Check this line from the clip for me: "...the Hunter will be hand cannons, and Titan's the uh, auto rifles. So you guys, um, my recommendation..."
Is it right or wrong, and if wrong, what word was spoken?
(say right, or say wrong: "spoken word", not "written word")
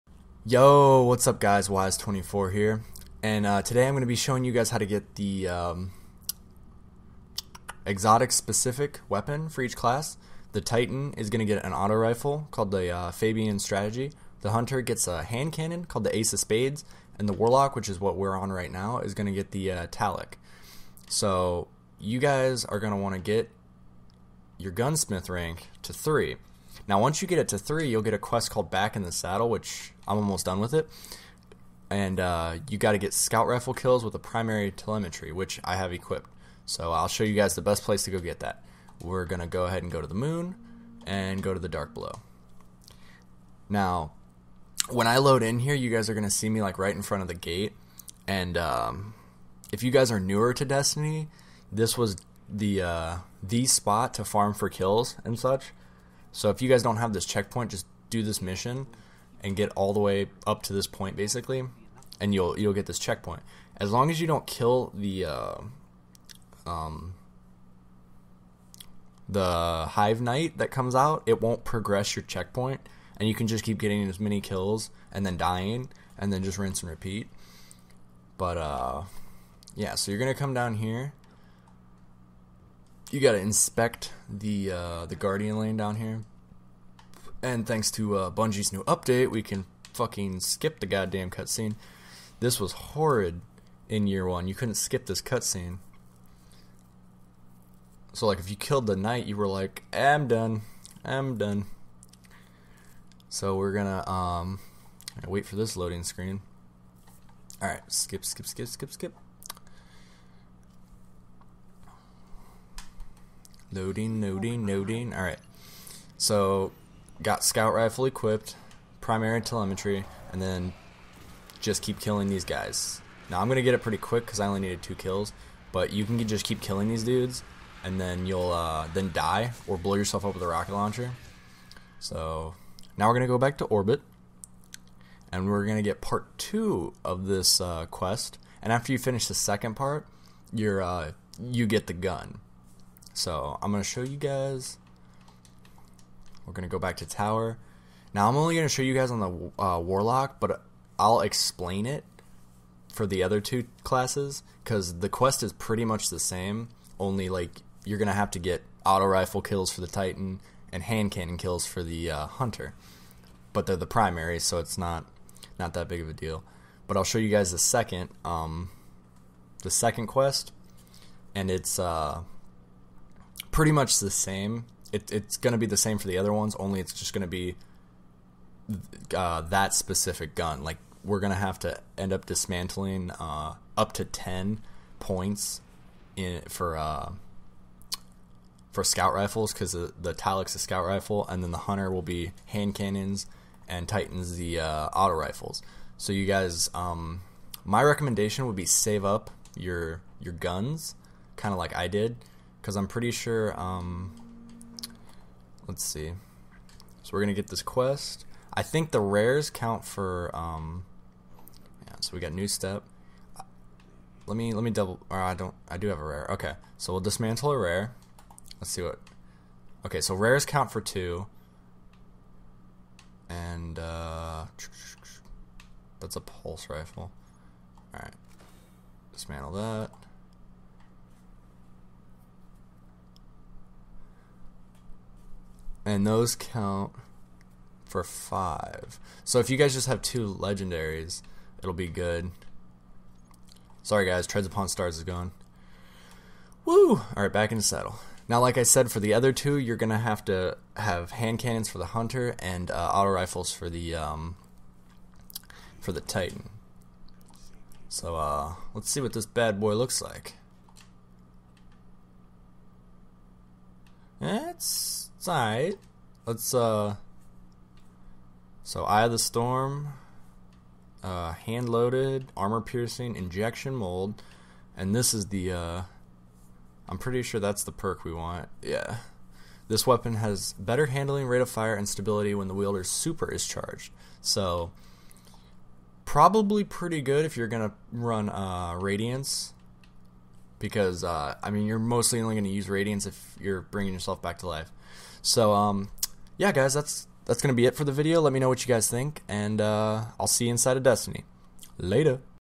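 right.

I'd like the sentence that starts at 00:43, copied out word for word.
Now, when I load in here, you guys are going to see me like right in front of the gate.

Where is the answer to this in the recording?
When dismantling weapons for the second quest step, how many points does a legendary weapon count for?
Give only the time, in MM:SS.
03:58.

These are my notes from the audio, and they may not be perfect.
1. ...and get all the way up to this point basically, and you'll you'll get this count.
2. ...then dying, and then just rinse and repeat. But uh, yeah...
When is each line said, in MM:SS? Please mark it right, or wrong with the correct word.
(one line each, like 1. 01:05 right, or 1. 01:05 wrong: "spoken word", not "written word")
1. 00:59 wrong: "checkpoint", not "count"
2. 01:15 right.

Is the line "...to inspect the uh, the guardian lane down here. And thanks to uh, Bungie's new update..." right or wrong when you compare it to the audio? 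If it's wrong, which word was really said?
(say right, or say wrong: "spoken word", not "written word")
right.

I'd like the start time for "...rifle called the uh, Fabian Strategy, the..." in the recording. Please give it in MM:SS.
00:11.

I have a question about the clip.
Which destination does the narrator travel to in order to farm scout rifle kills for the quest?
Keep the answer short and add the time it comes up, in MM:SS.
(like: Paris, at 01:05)
The moon, at 00:40.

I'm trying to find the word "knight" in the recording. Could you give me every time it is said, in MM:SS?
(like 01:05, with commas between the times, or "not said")
01:10, 01:38.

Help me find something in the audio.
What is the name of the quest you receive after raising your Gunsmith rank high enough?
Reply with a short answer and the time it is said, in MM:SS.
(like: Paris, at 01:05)
Back in the Saddle, at 00:28.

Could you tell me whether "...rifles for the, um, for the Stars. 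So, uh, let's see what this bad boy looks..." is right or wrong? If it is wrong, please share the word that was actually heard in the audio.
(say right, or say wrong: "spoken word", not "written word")
wrong: "Titan", not "Stars".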